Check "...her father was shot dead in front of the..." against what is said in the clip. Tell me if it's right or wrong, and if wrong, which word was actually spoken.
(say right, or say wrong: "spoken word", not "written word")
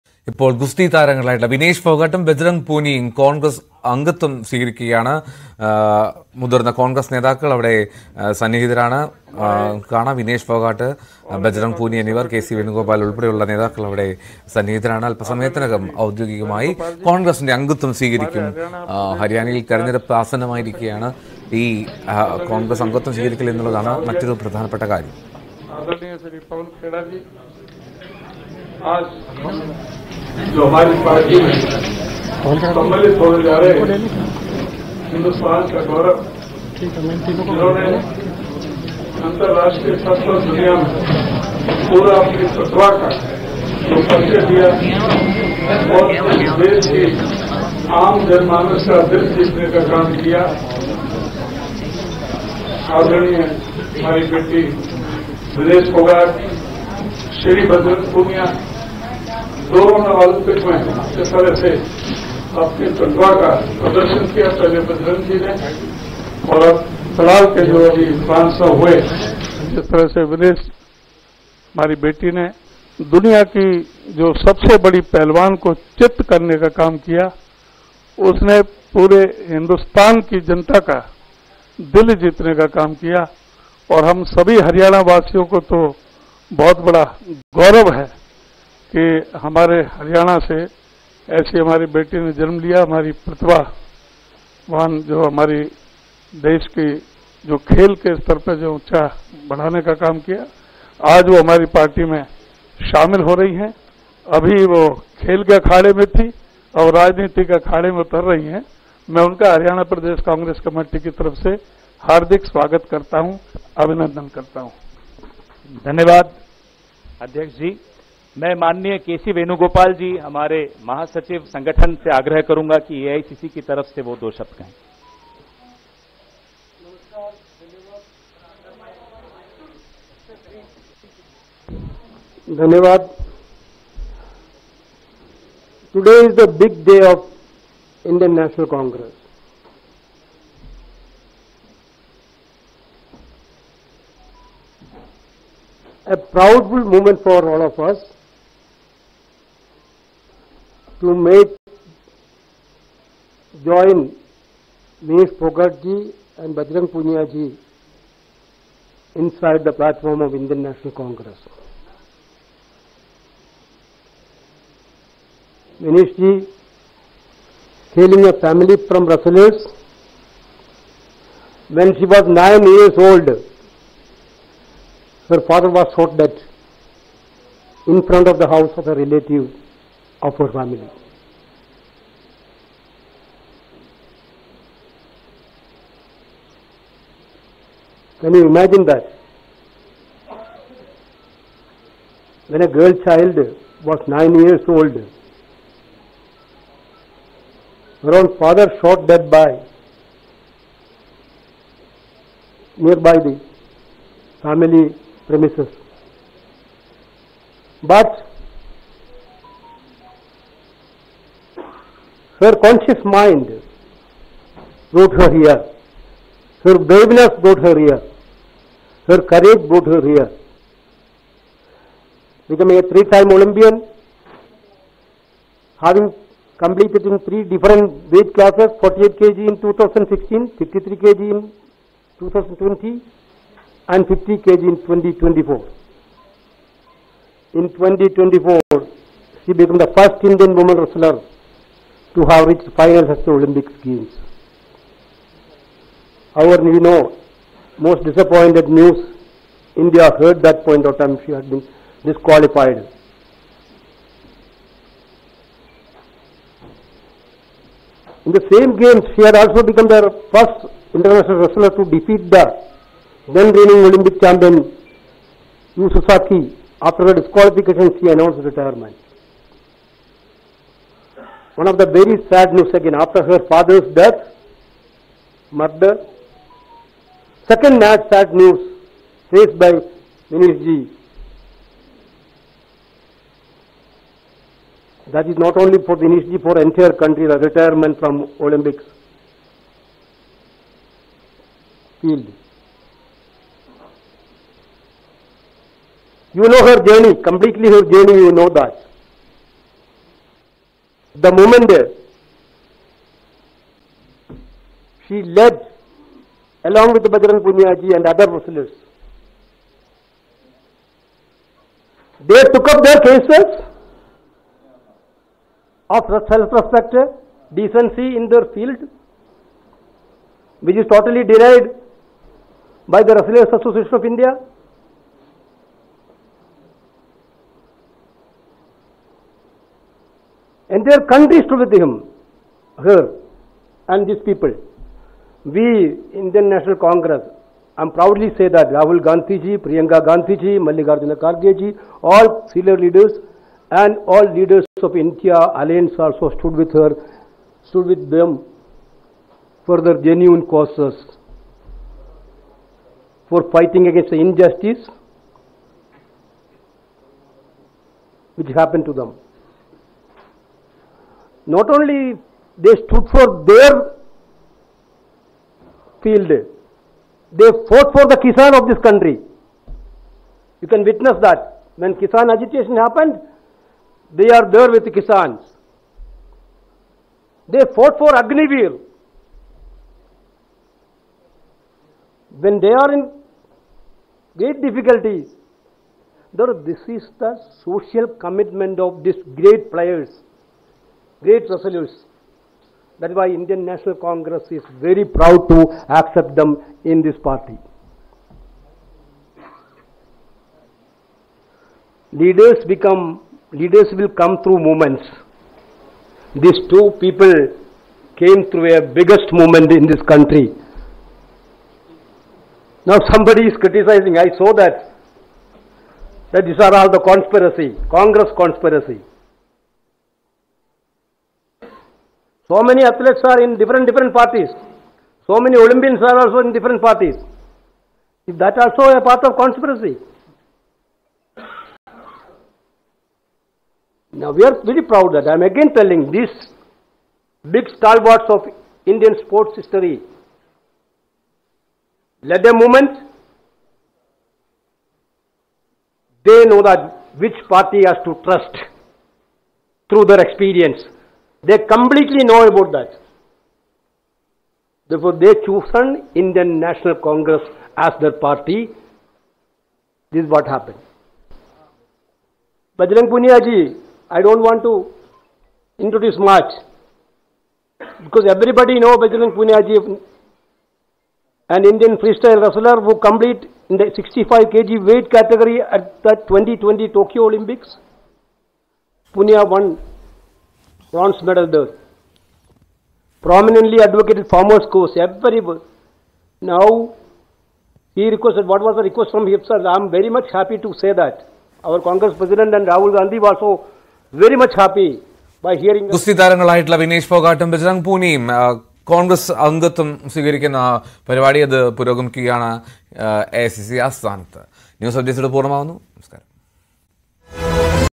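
right.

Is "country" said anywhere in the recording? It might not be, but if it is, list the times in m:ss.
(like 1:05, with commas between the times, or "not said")
4:47, 5:31, 6:08, 6:50.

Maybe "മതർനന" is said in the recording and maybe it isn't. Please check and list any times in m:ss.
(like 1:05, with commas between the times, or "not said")
0:06.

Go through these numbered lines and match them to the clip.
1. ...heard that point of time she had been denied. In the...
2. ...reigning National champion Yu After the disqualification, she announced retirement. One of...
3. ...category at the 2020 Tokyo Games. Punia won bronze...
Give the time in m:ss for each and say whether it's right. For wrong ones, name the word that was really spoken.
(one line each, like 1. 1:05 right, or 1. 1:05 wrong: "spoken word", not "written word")
1. 4:10 wrong: "disqualified", not "denied"
2. 4:23 wrong: "Olympic", not "National"
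3. 7:55 wrong: "Olympics", not "Games".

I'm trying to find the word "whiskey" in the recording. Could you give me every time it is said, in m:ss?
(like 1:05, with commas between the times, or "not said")
not said.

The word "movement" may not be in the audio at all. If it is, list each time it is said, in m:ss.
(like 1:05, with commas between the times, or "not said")
6:44, 6:49, 7:22.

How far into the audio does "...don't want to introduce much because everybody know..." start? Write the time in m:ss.
7:44.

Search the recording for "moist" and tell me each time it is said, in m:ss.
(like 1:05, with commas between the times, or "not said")
not said.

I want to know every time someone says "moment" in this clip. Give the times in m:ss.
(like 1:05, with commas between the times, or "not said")
2:26, 5:01.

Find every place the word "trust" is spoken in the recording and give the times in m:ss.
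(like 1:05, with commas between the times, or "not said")
7:28.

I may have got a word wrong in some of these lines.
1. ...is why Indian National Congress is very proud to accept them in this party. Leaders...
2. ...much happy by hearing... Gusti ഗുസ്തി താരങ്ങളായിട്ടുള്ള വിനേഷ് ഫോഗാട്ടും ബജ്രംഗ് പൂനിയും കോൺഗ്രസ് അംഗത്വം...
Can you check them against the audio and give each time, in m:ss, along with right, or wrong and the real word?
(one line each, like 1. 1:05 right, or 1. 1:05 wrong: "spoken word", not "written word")
1. 6:33 right
2. 8:14 right.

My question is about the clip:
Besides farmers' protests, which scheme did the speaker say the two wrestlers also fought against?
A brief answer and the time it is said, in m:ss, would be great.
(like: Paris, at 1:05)
Agnivir, at 6:18.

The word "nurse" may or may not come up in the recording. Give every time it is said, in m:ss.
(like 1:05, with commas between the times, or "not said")
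not said.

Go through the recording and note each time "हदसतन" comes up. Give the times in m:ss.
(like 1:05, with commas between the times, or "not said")
0:35, 1:19.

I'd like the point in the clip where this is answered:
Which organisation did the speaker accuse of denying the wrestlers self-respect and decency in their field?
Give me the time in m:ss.
5:23.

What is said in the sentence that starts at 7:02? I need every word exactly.
So many athletes are in different, different parties.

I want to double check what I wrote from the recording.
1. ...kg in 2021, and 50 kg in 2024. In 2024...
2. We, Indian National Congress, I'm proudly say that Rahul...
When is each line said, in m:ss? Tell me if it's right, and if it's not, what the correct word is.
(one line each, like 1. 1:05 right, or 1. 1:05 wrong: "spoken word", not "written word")
1. 3:51 wrong: "2020", not "2021"
2. 5:35 right.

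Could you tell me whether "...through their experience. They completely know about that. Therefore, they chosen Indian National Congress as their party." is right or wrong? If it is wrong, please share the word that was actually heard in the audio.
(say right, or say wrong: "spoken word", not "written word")
right.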